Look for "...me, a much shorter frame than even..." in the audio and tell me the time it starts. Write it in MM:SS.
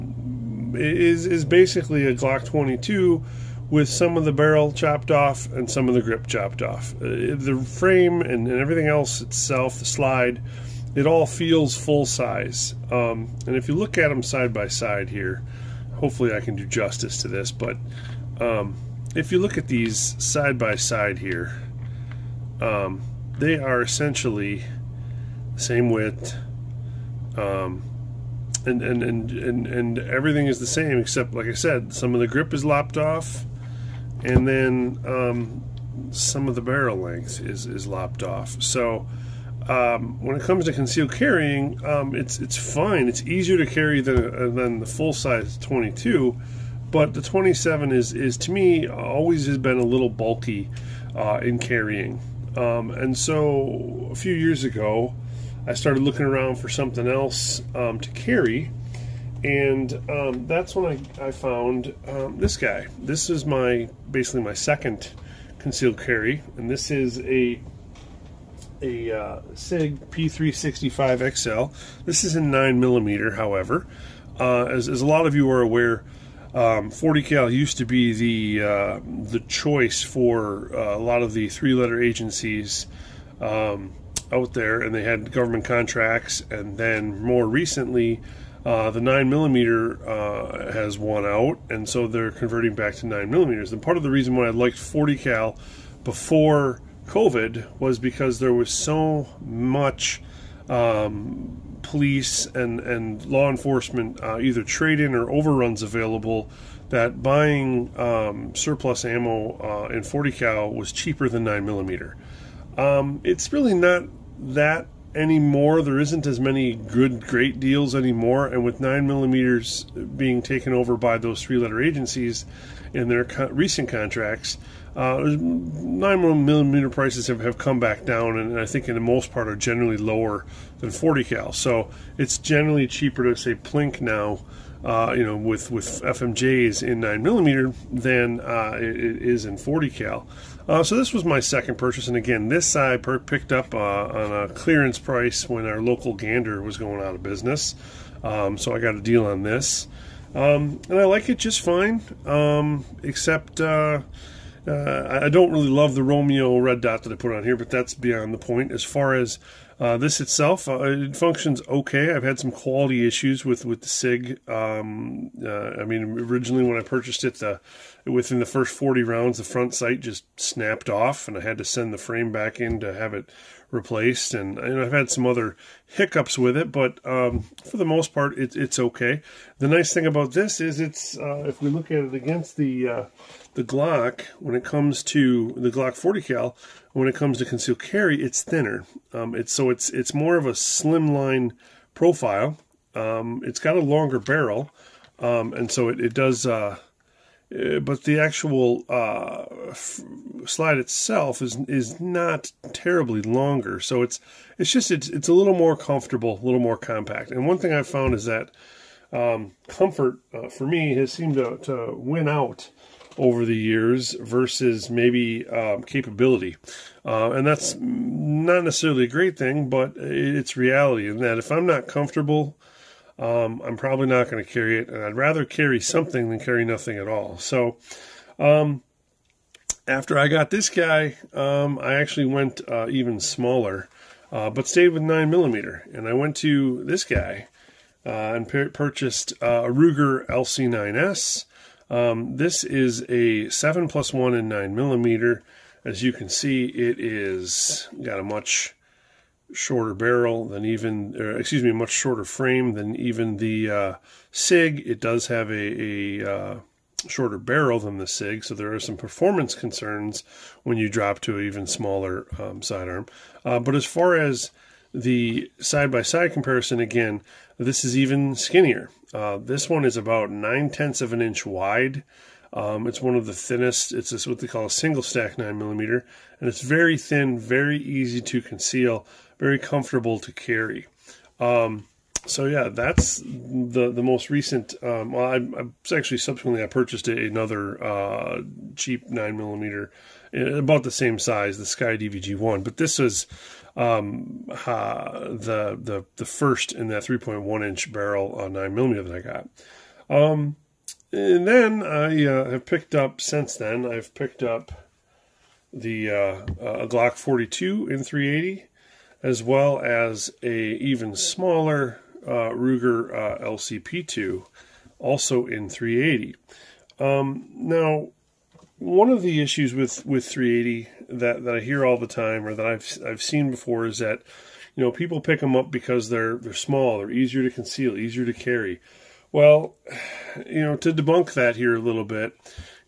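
04:11.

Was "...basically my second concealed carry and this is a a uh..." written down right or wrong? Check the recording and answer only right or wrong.
right.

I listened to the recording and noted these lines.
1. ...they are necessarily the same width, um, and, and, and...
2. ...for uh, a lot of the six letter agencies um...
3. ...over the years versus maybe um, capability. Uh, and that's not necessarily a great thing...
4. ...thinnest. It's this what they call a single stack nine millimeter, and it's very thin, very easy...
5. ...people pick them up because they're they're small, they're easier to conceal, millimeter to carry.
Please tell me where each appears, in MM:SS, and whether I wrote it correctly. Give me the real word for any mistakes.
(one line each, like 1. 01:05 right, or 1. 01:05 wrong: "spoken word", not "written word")
1. 00:23 wrong: "essentially", not "necessarily"
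2. 01:20 wrong: "three", not "six"
3. 03:33 right
4. 04:33 right
5. 05:24 wrong: "easier", not "millimeter".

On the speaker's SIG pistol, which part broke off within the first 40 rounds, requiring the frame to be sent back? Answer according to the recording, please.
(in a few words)
front sight.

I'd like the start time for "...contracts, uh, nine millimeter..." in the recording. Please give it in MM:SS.
02:03.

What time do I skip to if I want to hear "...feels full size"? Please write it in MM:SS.
00:11.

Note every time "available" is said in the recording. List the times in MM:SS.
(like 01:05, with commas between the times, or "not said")
01:45.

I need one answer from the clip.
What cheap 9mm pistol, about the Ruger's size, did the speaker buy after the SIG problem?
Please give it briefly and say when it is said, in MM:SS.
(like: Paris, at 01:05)
SCCY DVG one, at 04:51.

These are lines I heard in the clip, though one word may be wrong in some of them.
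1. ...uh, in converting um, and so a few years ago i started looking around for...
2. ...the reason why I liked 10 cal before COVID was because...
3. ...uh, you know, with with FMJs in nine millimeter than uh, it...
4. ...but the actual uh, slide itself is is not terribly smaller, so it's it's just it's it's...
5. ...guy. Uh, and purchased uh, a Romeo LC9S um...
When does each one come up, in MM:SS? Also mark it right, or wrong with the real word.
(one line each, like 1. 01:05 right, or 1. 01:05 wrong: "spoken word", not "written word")
1. 00:51 wrong: "carrying", not "converting"
2. 01:34 wrong: "40", not "10"
3. 02:14 right
4. 03:17 wrong: "longer", not "smaller"
5. 03:57 wrong: "Ruger", not "Romeo".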